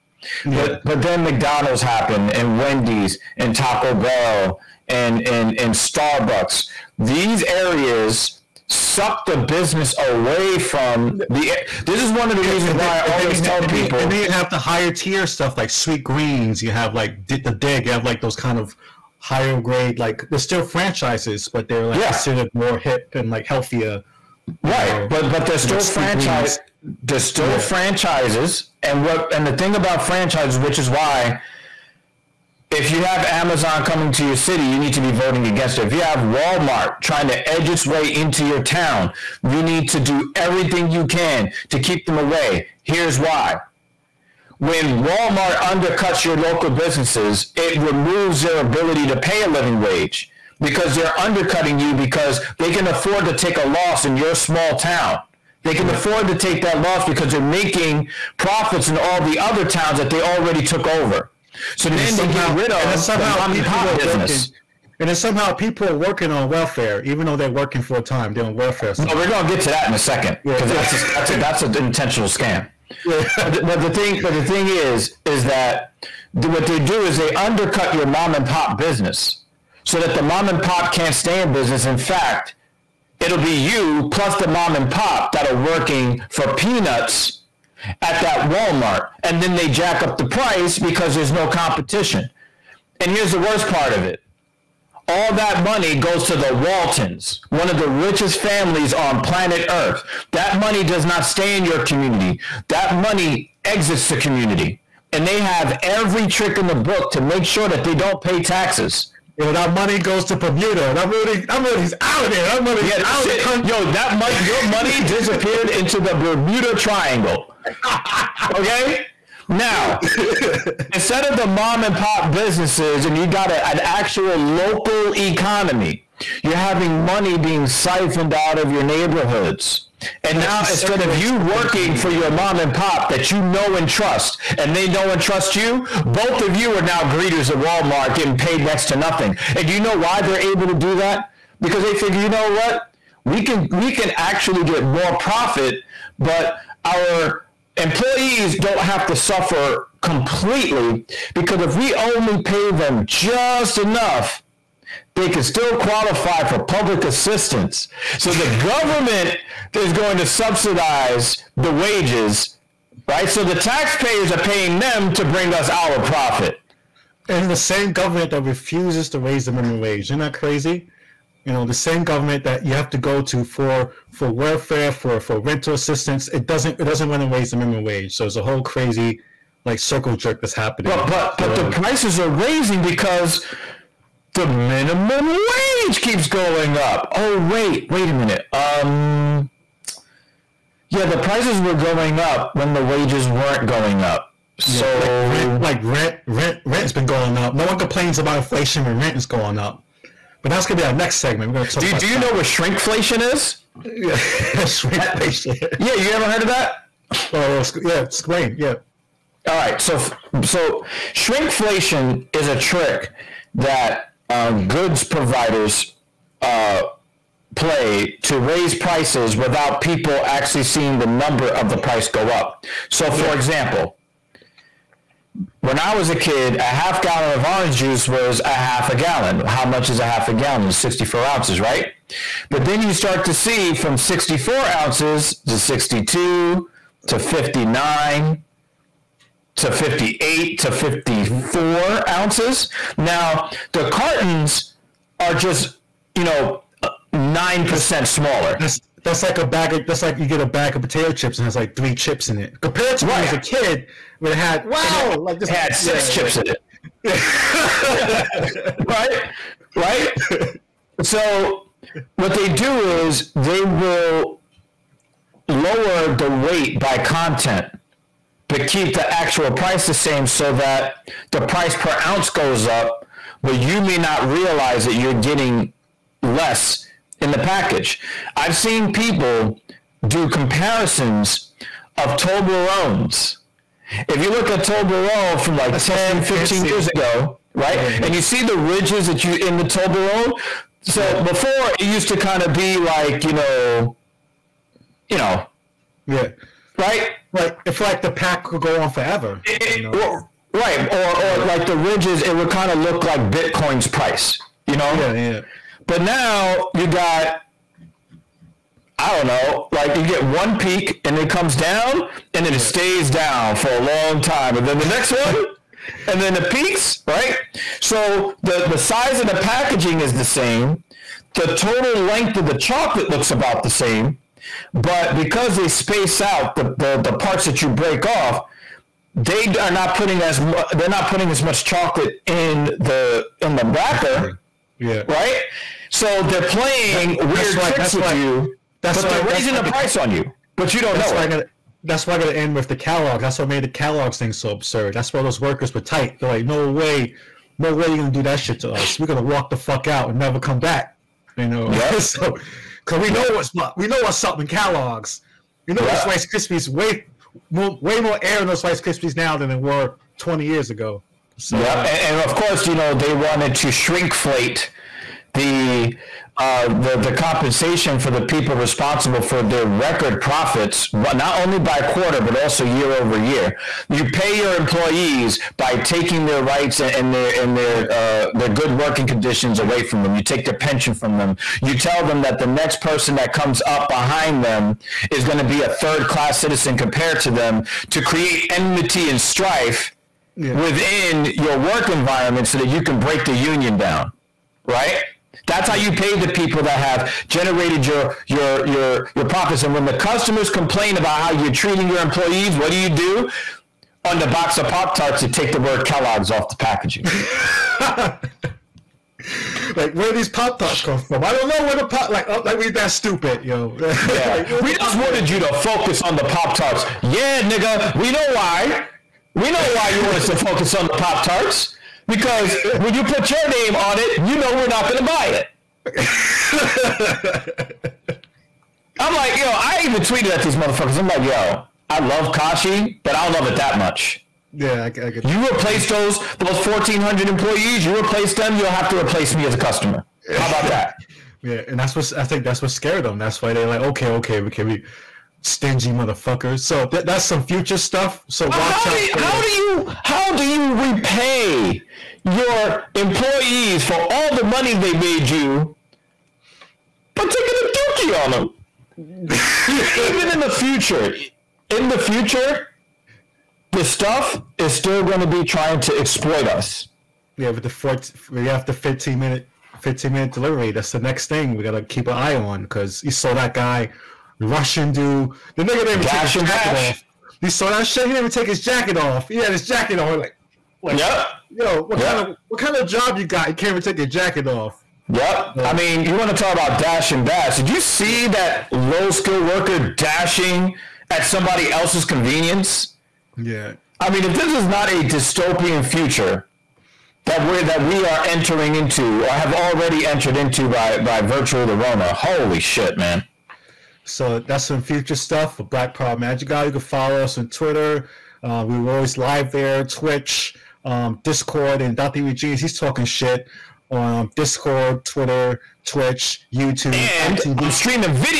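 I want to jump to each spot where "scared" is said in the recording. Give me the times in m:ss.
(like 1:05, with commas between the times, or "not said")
7:22.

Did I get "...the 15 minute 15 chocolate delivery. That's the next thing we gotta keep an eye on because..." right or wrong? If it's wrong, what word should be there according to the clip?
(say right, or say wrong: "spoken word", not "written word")
wrong: "minute", not "chocolate".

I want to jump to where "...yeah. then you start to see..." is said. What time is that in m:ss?
3:52.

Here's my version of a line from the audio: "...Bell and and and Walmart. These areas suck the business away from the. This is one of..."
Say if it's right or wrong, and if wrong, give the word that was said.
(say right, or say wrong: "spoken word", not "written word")
wrong: "Starbucks", not "Walmart".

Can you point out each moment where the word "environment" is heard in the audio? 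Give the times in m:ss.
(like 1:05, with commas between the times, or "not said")
6:31.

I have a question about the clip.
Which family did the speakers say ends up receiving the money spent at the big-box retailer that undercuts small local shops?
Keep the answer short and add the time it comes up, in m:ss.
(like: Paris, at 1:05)
The Waltons, at 1:36.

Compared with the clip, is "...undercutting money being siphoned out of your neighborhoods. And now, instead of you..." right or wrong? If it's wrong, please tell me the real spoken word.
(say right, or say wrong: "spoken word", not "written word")
wrong: "having", not "undercutting".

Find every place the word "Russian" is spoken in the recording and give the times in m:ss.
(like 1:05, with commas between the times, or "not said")
7:54.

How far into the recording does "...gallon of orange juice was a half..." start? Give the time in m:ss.
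3:47.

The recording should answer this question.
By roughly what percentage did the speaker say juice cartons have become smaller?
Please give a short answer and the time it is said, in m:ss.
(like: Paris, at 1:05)
9%, at 4:07.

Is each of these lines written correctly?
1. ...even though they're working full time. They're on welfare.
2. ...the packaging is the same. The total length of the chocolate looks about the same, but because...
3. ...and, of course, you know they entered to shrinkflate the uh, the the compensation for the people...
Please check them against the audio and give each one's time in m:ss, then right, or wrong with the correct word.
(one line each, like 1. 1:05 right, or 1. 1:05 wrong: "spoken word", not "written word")
1. 1:07 right
2. 5:19 right
3. 6:02 wrong: "wanted", not "entered".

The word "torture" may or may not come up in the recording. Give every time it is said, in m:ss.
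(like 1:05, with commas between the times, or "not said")
not said.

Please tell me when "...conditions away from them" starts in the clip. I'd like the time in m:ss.
6:19.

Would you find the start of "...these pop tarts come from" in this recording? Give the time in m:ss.
6:50.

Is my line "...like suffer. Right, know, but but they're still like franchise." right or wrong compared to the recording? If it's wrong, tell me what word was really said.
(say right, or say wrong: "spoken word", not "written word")
wrong: "healthier", not "suffer".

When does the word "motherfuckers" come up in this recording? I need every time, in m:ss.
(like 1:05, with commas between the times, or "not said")
7:10, 7:25.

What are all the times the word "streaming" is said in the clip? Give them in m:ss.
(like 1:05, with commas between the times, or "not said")
8:37.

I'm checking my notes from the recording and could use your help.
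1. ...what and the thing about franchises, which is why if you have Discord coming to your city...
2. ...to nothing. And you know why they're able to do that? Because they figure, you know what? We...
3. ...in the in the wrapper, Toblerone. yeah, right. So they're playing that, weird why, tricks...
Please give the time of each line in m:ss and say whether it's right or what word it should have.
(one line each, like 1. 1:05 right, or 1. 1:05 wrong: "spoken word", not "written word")
1. 0:29 wrong: "Amazon", not "Discord"
2. 2:18 right
3. 5:32 wrong: "Definitely", not "Toblerone".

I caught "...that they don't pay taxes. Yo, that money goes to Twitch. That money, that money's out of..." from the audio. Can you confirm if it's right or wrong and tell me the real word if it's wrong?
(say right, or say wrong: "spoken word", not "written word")
wrong: "Bermuda", not "Twitch".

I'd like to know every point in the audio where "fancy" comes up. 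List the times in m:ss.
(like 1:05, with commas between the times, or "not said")
4:46.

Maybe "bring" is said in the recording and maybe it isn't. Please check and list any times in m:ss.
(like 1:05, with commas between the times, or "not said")
2:45.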